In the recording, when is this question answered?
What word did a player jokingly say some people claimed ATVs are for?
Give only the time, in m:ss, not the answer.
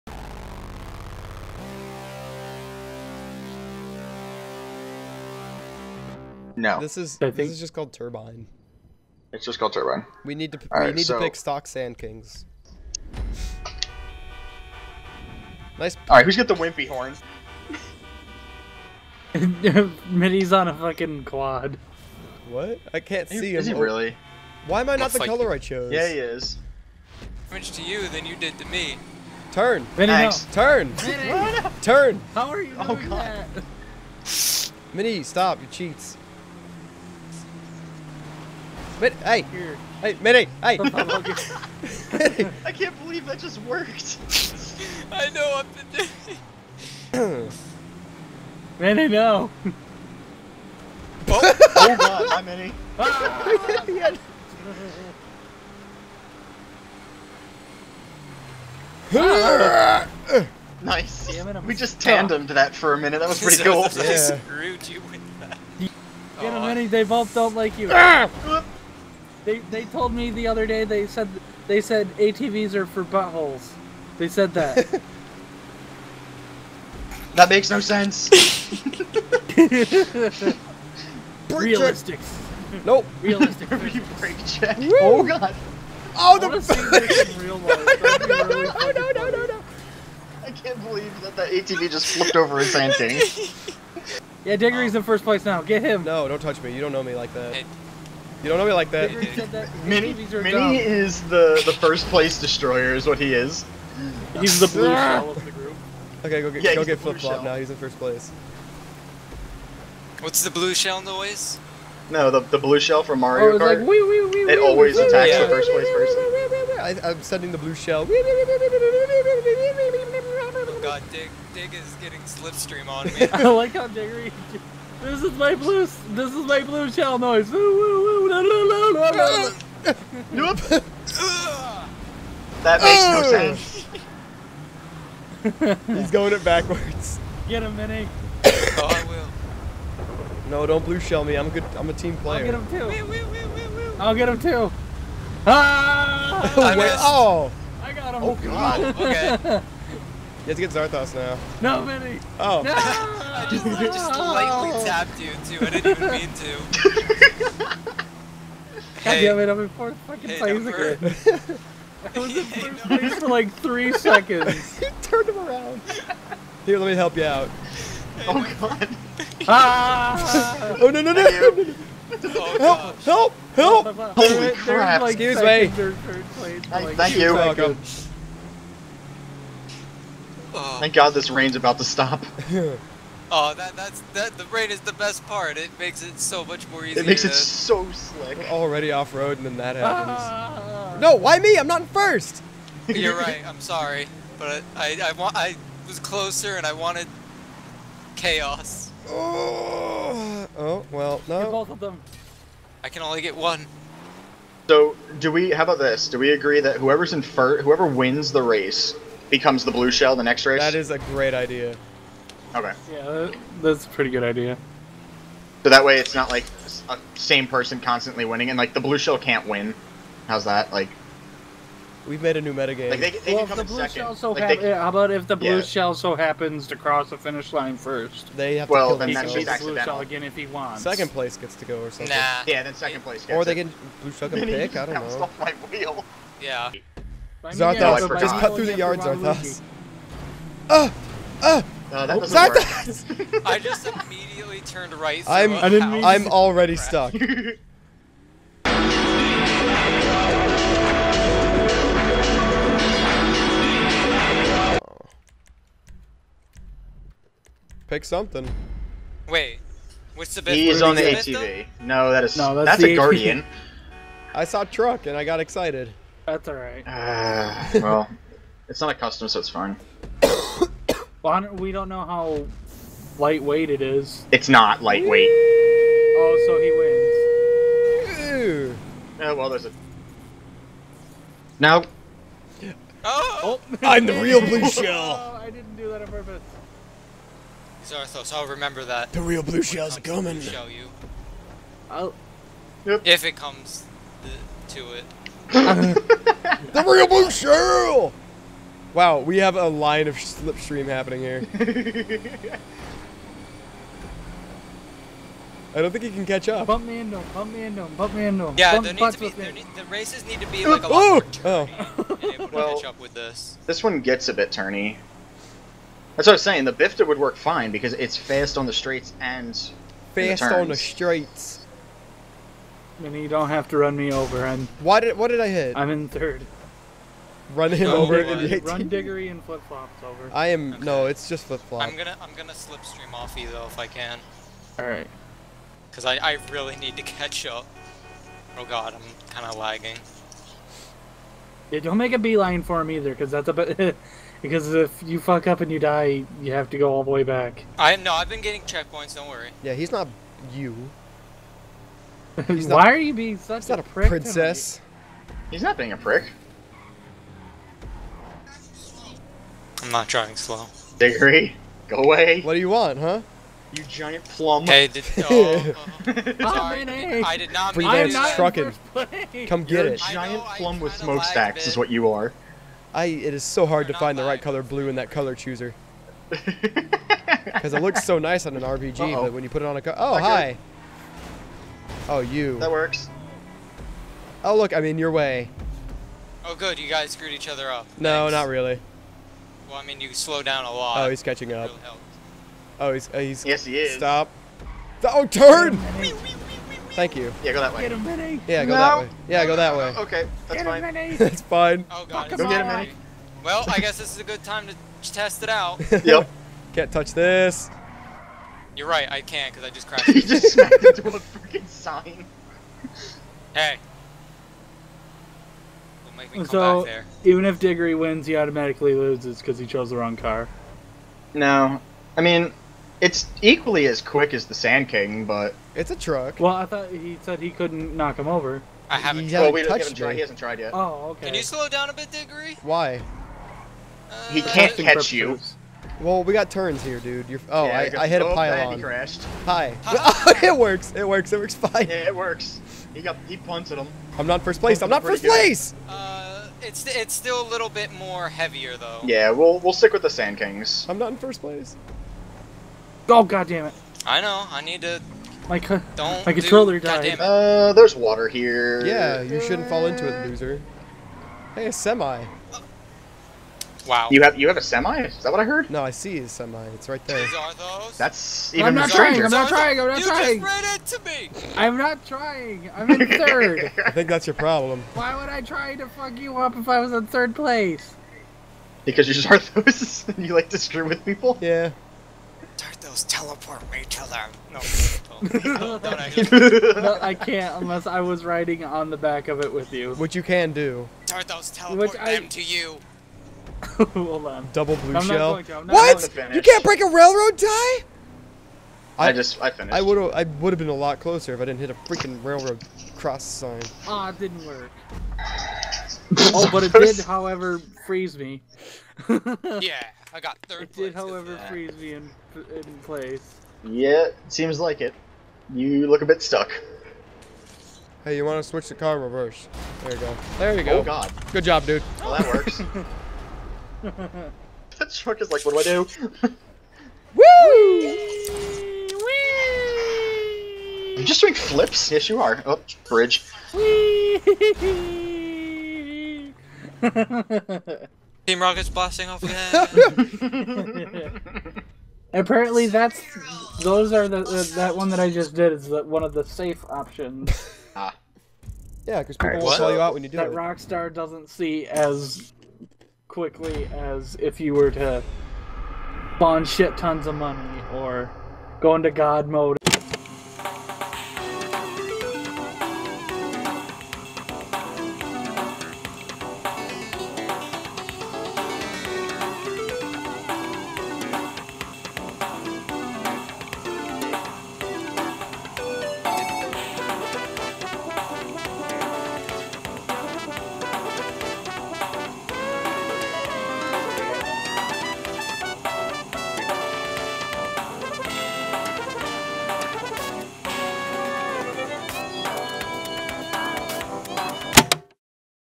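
1:12.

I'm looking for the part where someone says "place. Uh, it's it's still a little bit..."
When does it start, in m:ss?
7:25.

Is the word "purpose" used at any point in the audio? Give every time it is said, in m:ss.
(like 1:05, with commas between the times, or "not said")
4:46, 7:14.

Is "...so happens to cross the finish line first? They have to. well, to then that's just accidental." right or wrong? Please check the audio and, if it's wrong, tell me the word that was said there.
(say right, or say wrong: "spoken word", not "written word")
right.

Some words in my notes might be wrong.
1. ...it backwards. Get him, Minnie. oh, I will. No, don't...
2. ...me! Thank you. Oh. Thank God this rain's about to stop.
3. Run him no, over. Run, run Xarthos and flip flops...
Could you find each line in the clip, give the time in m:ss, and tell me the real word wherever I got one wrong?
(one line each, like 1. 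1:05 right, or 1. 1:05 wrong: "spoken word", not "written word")
1. 2:16 right
2. 2:55 right
3. 5:27 wrong: "Diggery", not "Xarthos".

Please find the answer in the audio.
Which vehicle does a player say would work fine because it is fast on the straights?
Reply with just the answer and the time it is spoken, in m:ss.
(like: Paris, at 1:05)
Bifta, at 5:16.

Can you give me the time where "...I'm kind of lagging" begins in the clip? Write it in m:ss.
5:38.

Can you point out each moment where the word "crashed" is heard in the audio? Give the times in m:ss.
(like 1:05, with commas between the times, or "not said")
6:49, 7:18.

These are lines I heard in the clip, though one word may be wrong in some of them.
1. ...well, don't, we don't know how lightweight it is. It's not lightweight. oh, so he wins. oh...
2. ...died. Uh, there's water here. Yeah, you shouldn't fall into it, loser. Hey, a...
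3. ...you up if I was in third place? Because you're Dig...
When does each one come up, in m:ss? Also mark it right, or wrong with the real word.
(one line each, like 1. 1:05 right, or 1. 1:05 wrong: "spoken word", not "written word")
1. 4:30 right
2. 7:36 right
3. 7:56 wrong: "Xarthos", not "Dig".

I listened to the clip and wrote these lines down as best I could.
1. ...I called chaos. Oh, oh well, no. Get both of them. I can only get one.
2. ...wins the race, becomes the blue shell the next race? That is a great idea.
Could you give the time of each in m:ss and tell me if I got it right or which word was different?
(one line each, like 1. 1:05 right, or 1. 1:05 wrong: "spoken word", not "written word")
1. 3:16 wrong: "wanted", not "called"
2. 3:27 right.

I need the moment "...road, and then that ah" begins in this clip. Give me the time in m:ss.
3:09.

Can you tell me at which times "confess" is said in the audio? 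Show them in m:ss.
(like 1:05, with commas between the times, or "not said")
not said.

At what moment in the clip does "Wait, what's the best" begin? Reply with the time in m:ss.
4:19.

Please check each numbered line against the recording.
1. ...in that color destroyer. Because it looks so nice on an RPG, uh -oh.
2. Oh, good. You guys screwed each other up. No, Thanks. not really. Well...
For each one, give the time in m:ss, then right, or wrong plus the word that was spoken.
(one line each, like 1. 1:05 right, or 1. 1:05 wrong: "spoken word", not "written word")
1. 6:14 wrong: "chooser", not "destroyer"
2. 6:26 right.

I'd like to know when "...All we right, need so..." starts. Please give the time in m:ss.
0:10.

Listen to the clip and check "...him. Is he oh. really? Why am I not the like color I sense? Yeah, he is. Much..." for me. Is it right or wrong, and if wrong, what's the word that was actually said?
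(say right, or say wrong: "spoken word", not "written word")
wrong: "chose", not "sense".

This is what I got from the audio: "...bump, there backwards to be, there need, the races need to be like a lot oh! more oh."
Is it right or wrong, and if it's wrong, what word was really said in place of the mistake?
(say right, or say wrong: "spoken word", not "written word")
wrong: "needs", not "backwards".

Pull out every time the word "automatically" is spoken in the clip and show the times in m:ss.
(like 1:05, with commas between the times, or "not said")
6:58.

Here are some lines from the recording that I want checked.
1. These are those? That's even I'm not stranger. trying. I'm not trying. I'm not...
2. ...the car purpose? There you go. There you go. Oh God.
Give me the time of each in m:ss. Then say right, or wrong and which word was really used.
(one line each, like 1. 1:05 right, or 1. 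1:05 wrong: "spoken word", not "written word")
1. 7:47 right
2. 8:38 wrong: "reverse", not "purpose".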